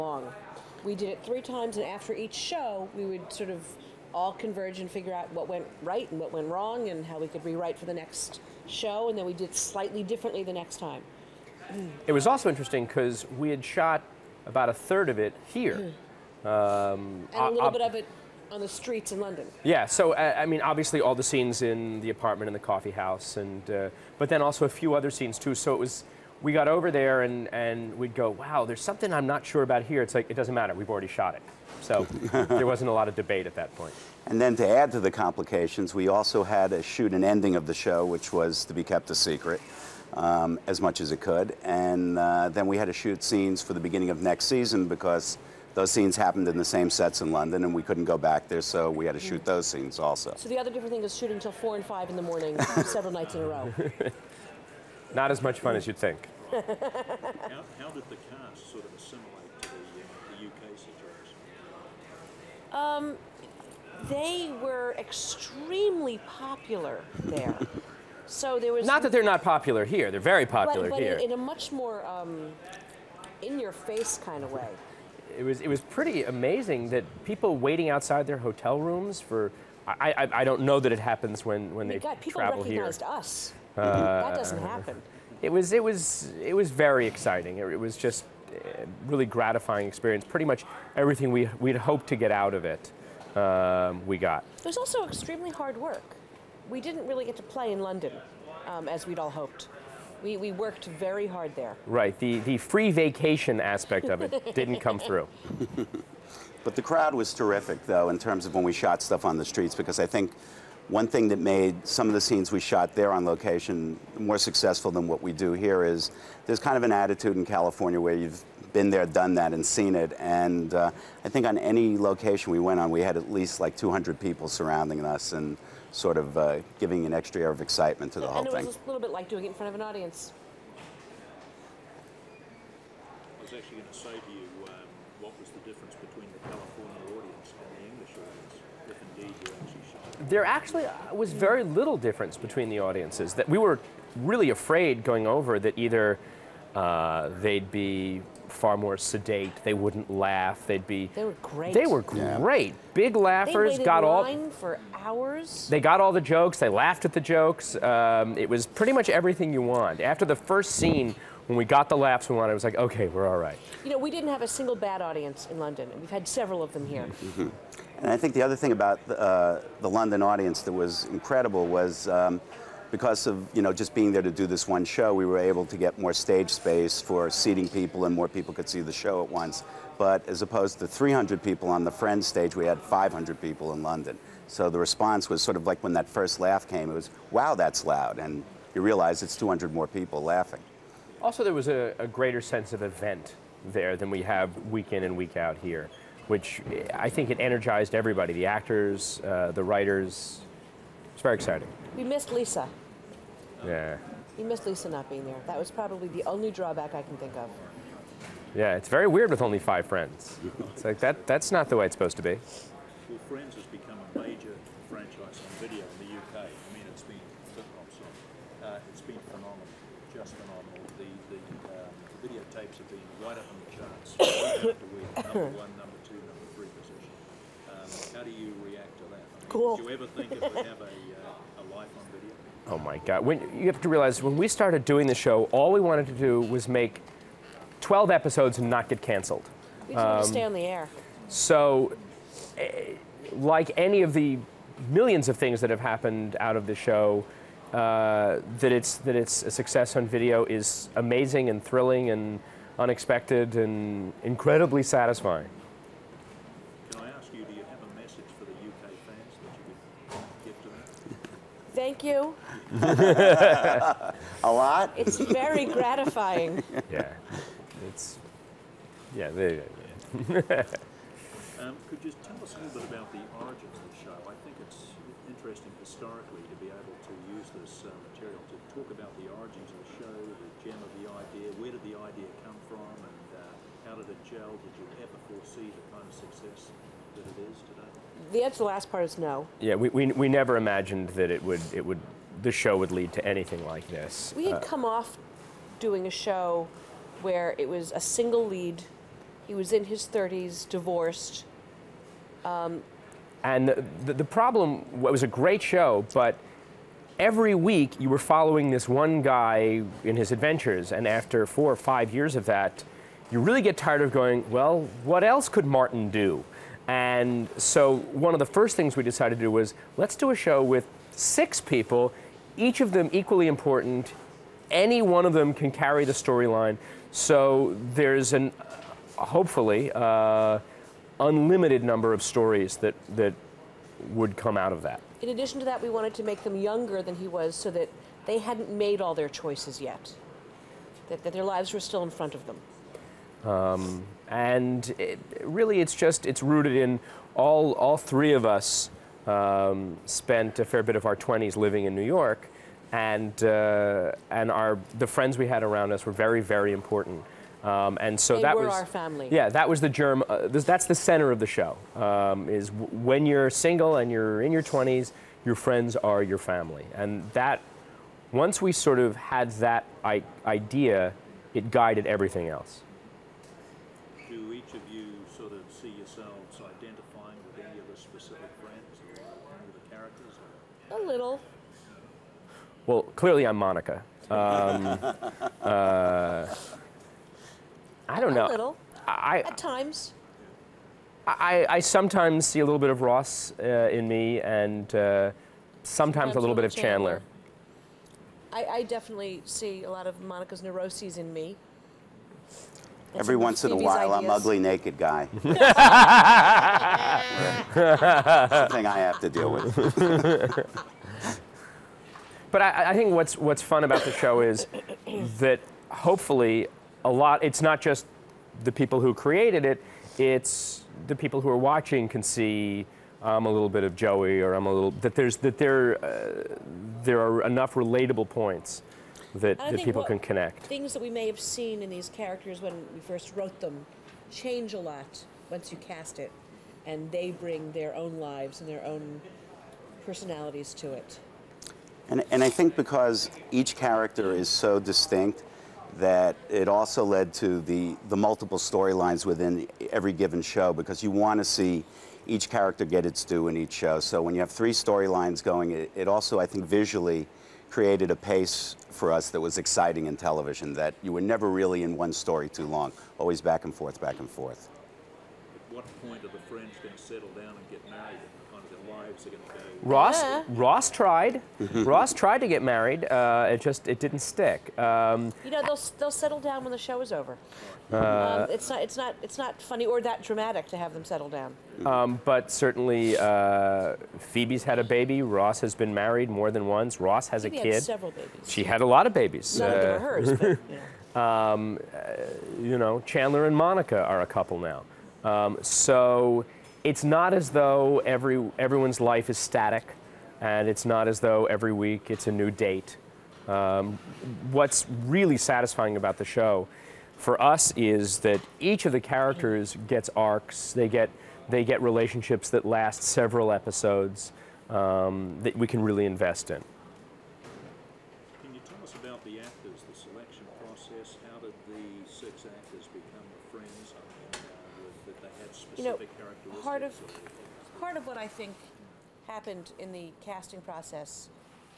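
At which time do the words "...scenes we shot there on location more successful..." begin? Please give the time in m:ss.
1:52.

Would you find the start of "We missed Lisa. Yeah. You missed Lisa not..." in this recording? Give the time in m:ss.
3:21.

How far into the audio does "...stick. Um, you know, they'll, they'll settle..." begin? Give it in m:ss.
7:54.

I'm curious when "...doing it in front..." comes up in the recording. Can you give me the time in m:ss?
2:09.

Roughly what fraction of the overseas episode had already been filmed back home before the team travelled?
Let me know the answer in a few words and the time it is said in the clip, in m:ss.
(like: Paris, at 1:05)
a third, at 0:14.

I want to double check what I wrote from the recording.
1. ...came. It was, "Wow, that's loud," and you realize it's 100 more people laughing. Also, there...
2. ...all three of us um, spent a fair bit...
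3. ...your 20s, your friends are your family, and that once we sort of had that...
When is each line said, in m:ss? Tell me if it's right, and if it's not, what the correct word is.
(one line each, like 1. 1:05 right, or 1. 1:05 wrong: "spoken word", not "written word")
1. 3:06 wrong: "200", not "100"
2. 5:47 right
3. 6:04 right.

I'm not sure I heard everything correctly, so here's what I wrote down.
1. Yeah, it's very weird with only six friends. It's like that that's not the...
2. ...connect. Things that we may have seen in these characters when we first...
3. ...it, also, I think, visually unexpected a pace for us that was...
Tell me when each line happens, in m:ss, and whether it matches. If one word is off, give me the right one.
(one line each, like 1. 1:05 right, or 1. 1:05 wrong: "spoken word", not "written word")
1. 3:28 wrong: "five", not "six"
2. 7:10 right
3. 7:35 wrong: "created", not "unexpected".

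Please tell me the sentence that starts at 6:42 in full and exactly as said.
That's Every once in a while, ideas.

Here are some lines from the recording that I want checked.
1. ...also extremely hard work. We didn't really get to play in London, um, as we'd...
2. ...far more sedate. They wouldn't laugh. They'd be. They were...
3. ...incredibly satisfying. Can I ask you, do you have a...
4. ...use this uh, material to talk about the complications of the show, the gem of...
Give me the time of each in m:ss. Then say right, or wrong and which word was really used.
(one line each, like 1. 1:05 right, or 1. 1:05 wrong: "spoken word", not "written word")
1. 1:34 right
2. 2:28 right
3. 4:14 right
4. 4:37 wrong: "origins", not "complications".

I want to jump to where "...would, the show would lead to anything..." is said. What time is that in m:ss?
4:51.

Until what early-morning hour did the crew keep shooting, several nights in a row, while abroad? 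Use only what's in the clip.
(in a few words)
4 and 5 in the morning.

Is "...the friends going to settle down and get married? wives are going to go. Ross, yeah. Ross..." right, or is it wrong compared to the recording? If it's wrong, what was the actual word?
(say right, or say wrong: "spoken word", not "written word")
right.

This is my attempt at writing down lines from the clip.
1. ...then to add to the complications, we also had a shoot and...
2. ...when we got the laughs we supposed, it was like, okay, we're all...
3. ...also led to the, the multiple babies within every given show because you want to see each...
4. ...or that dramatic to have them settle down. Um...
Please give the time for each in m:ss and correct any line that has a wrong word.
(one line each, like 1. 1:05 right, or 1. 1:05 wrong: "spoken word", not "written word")
1. 0:34 right
2. 2:41 wrong: "wanted", not "supposed"
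3. 7:26 wrong: "storylines", not "babies"
4. 7:59 right.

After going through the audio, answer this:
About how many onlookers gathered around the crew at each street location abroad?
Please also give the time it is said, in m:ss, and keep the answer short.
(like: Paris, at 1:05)
200, at 2:03.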